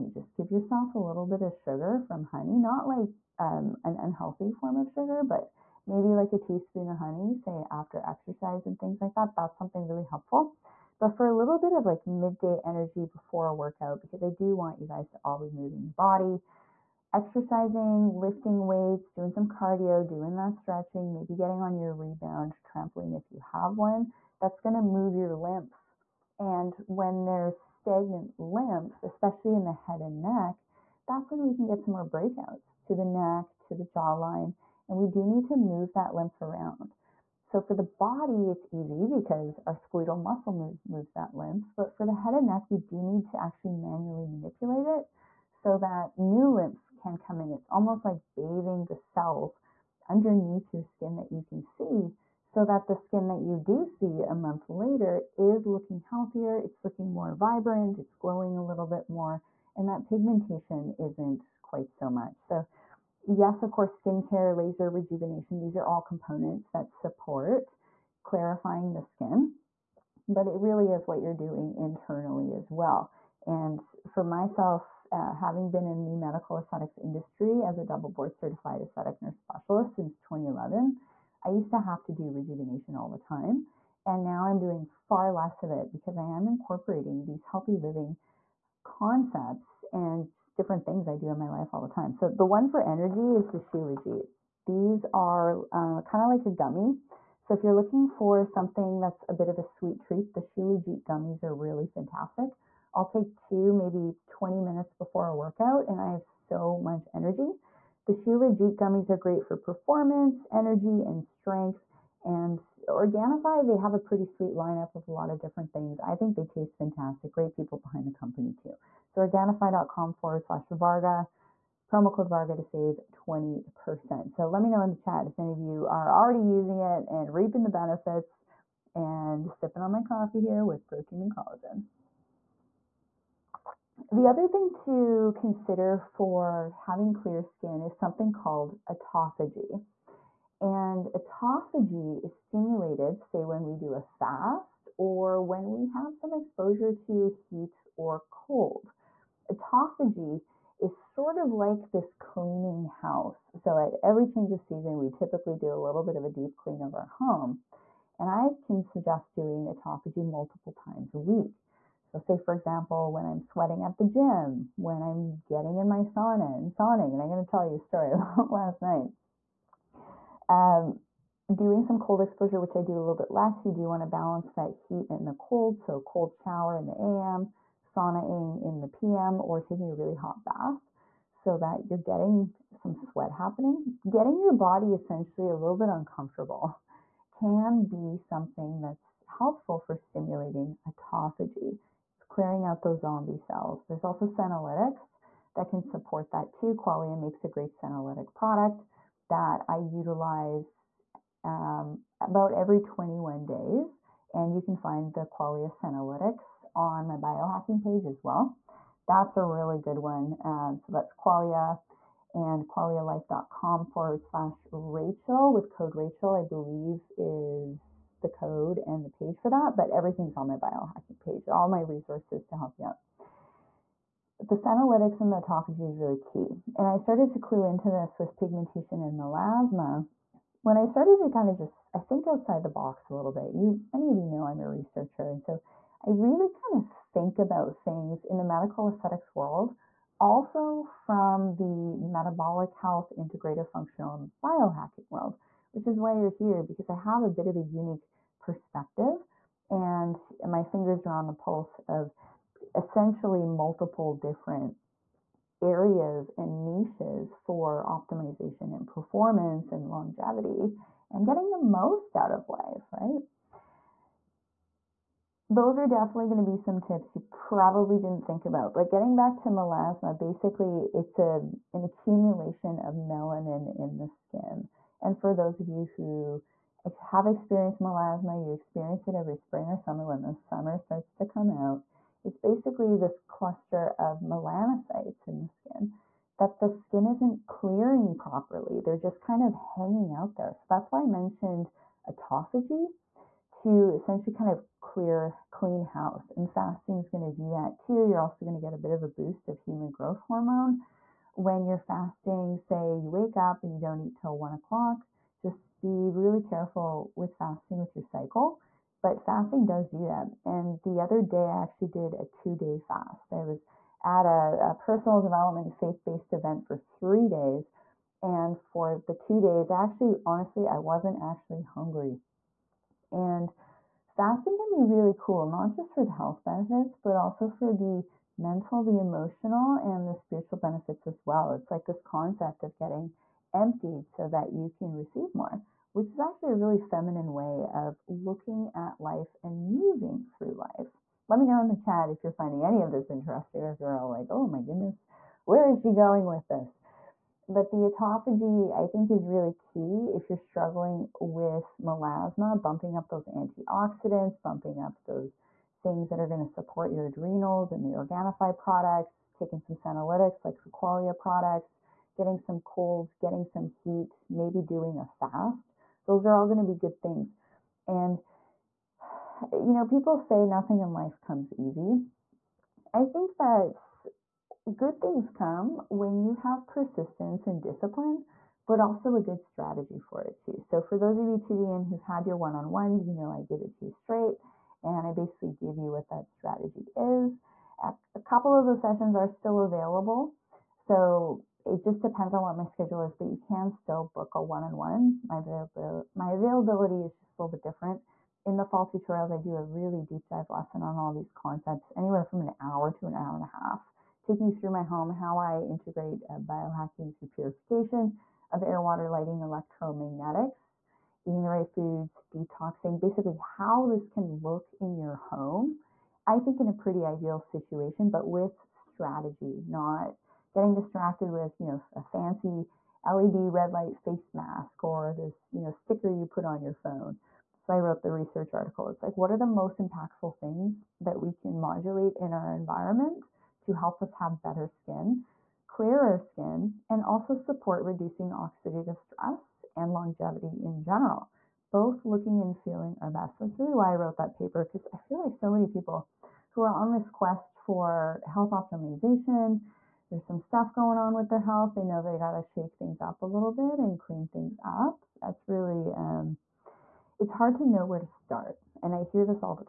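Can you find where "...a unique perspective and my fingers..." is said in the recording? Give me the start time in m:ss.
4:07.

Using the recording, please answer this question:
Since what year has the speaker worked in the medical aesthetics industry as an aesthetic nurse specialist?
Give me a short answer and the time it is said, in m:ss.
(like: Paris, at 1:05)
2011, at 1:20.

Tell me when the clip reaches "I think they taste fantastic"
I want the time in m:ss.
1:55.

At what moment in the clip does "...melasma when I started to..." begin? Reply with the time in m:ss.
3:49.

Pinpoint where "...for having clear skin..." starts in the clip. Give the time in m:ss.
2:15.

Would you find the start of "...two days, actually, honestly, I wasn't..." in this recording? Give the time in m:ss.
5:19.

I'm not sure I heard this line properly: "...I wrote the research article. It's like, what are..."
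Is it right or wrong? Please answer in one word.
right.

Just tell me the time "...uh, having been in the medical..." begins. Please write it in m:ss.
1:15.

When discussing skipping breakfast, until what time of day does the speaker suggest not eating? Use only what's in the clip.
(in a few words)
1 o'clock.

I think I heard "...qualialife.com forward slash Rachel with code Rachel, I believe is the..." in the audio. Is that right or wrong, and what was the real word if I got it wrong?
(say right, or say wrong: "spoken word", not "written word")
right.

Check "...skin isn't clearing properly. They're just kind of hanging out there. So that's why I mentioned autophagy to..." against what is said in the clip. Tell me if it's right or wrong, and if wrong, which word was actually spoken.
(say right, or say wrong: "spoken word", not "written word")
right.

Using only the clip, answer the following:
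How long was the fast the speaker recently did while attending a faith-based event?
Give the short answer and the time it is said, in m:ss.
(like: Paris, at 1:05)
2 days, at 5:12.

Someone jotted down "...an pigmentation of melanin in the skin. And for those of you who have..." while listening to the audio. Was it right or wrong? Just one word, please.
wrong.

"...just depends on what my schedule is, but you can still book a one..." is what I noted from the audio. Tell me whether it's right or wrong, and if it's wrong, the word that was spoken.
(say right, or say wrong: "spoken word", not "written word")
right.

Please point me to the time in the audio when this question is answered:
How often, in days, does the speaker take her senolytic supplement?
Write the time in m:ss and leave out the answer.
3:22.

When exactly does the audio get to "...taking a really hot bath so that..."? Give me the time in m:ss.
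2:59.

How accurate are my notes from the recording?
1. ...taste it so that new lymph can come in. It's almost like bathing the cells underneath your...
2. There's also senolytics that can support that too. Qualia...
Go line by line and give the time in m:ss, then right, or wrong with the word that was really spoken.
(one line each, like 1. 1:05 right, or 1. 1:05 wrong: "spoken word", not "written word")
1. 0:44 wrong: "manipulate", not "taste"
2. 3:13 right.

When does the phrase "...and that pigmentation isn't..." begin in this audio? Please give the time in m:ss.
0:59.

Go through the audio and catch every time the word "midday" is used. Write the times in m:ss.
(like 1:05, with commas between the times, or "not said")
0:12.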